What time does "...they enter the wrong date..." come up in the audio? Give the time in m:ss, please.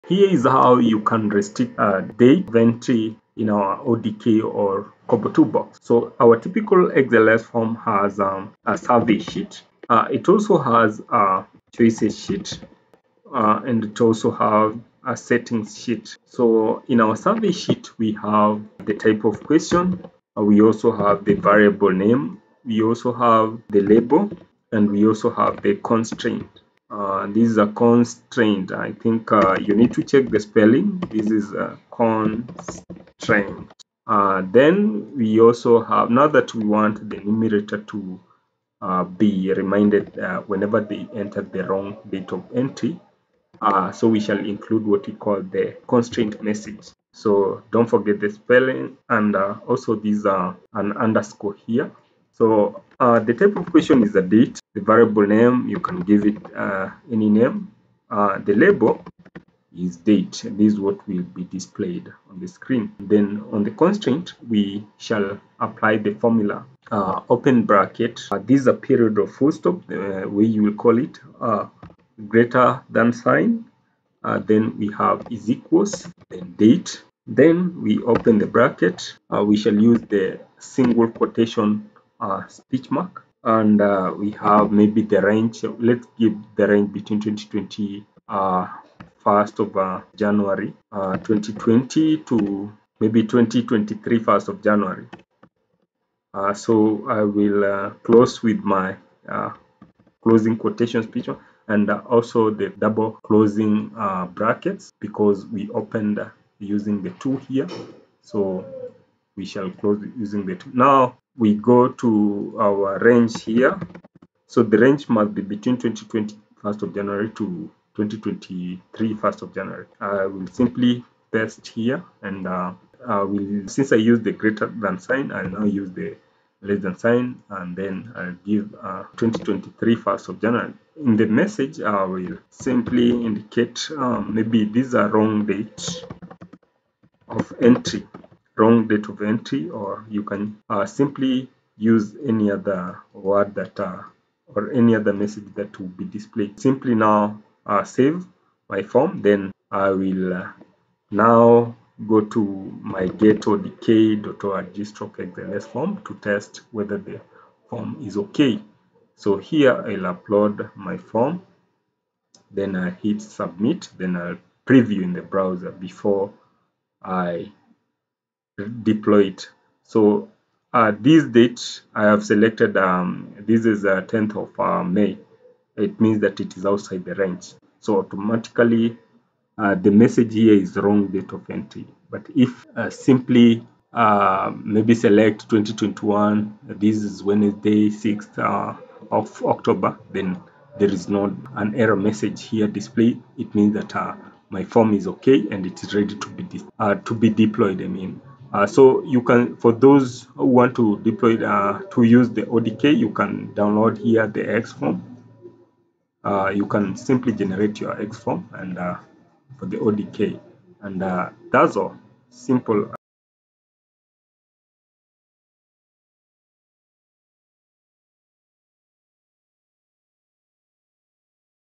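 0:40.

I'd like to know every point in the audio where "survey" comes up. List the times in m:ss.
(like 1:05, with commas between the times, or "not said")
0:08, 0:17.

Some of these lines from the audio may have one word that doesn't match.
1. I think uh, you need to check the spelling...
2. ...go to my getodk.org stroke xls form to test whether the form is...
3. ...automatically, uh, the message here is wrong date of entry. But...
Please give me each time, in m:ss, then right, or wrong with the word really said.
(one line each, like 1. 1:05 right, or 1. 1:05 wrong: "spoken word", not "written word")
1. 0:28 right
2. 2:32 right
3. 2:57 right.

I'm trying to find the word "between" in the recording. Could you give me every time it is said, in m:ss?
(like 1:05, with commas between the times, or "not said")
1:26, 1:55.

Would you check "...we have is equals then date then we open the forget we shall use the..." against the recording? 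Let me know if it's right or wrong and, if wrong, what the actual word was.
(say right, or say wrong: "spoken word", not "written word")
wrong: "bracket", not "forget".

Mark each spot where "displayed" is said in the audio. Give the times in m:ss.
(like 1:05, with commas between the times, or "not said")
1:01, 2:26, 3:12.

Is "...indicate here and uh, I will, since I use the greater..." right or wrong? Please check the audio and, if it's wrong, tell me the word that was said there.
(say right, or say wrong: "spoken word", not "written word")
wrong: "paste", not "indicate".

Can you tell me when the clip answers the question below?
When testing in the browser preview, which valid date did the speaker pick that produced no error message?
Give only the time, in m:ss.
3:07.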